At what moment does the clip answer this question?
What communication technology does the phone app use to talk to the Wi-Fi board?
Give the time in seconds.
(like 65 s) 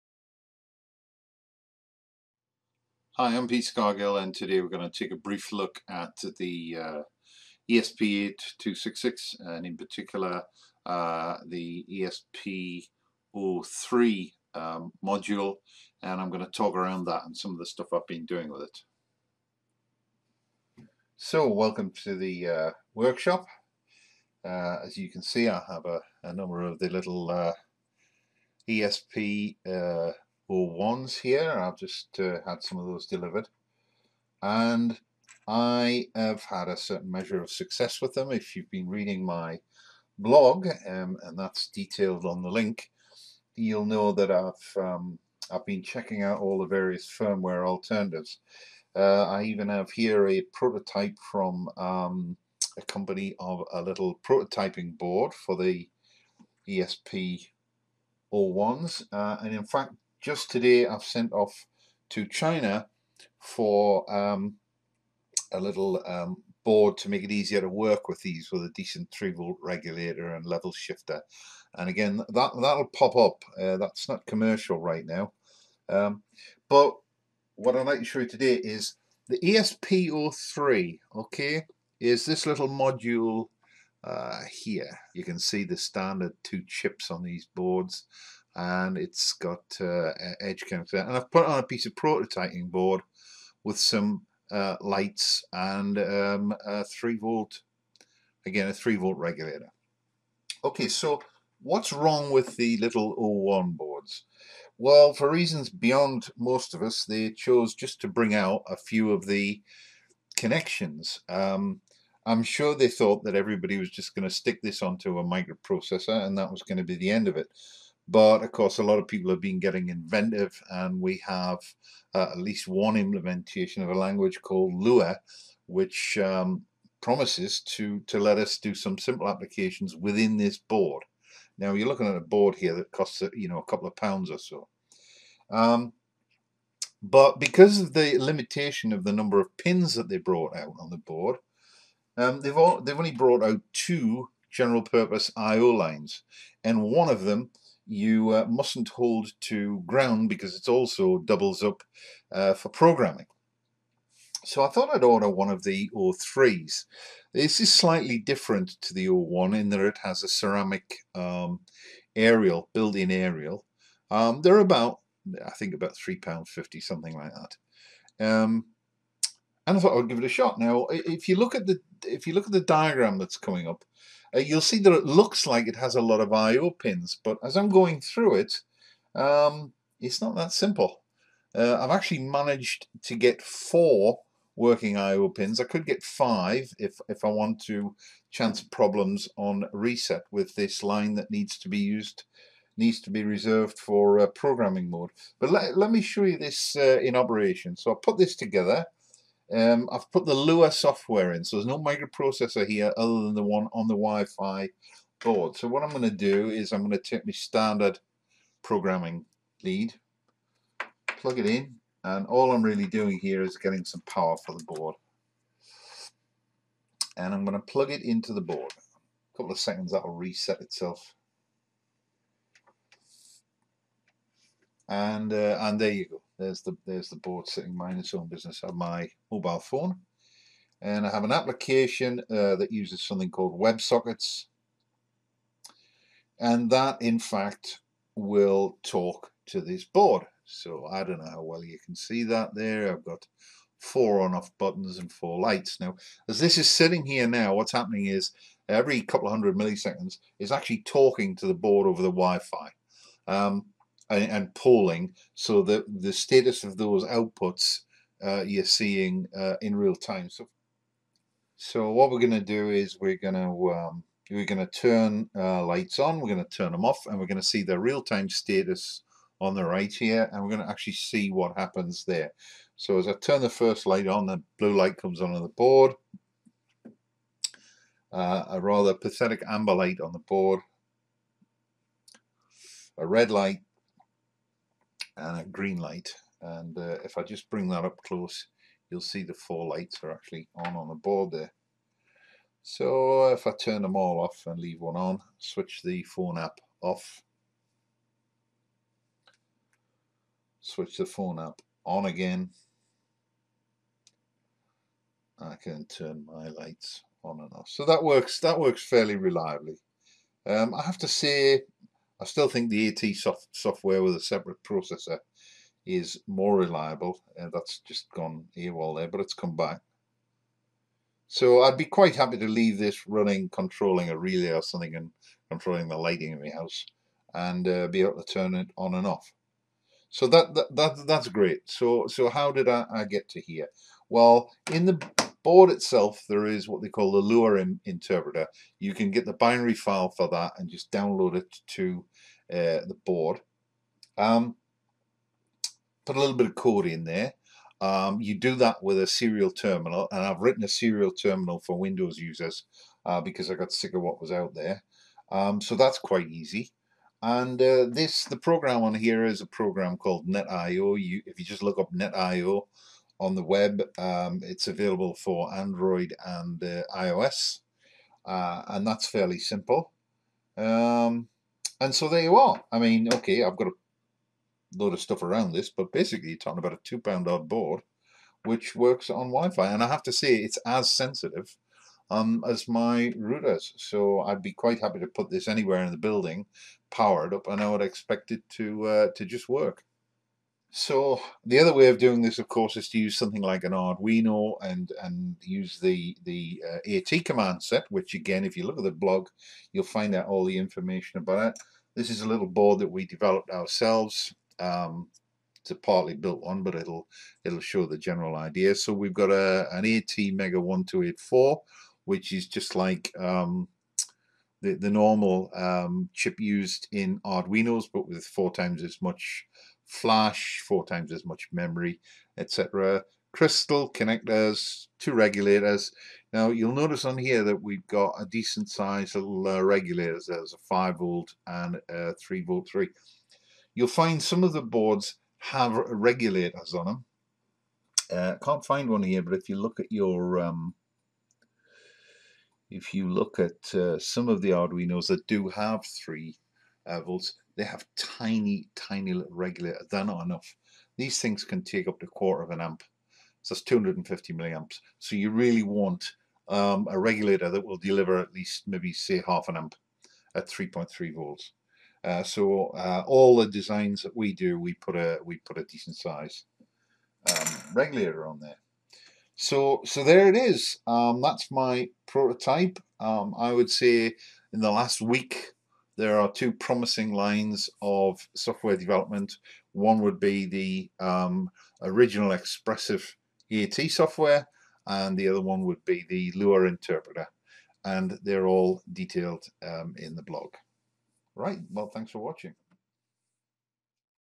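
233 s.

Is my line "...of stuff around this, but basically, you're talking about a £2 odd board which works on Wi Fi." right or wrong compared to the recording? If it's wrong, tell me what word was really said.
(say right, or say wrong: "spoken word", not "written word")
right.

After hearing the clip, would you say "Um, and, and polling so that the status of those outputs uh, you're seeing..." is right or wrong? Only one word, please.
right.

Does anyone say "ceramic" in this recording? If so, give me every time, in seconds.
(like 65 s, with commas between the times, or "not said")
160 s.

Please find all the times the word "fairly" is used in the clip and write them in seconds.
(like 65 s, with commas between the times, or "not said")
308 s, 369 s.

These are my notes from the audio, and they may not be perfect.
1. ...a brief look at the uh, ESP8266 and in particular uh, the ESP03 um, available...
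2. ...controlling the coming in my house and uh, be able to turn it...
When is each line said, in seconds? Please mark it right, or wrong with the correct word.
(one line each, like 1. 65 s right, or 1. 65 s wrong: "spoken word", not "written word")
1. 5 s wrong: "module", not "available"
2. 325 s wrong: "lighting", not "coming".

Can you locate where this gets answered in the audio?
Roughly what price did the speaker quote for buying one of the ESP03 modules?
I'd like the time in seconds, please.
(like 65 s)
165 s.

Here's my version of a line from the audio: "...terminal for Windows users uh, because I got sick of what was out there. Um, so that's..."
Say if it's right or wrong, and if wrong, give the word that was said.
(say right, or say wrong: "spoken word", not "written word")
right.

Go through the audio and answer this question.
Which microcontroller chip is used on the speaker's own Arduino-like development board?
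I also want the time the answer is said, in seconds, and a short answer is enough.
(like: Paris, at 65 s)
ATmega 1284, at 409 s.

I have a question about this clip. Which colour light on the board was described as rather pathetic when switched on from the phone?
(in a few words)
Amber.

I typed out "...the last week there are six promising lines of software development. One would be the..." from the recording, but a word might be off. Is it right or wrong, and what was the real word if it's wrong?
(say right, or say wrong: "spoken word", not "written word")
wrong: "two", not "six".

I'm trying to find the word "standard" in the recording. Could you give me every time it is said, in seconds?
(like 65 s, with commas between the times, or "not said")
85 s, 207 s.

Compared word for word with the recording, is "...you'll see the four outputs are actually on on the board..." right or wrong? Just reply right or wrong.
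wrong.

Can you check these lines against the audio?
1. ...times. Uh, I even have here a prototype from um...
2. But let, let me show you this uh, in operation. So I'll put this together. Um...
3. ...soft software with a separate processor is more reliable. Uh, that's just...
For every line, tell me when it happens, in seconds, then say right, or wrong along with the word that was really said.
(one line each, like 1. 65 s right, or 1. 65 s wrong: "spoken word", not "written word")
1. 47 s wrong: "alternatives", not "times"
2. 195 s right
3. 313 s right.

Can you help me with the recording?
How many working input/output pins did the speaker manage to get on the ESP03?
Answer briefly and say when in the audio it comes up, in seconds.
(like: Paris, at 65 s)
4, at 183 s.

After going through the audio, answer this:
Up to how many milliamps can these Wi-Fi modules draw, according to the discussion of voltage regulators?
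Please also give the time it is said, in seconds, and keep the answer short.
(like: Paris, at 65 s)
250, at 453 s.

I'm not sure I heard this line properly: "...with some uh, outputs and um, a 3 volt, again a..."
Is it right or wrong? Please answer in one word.
wrong.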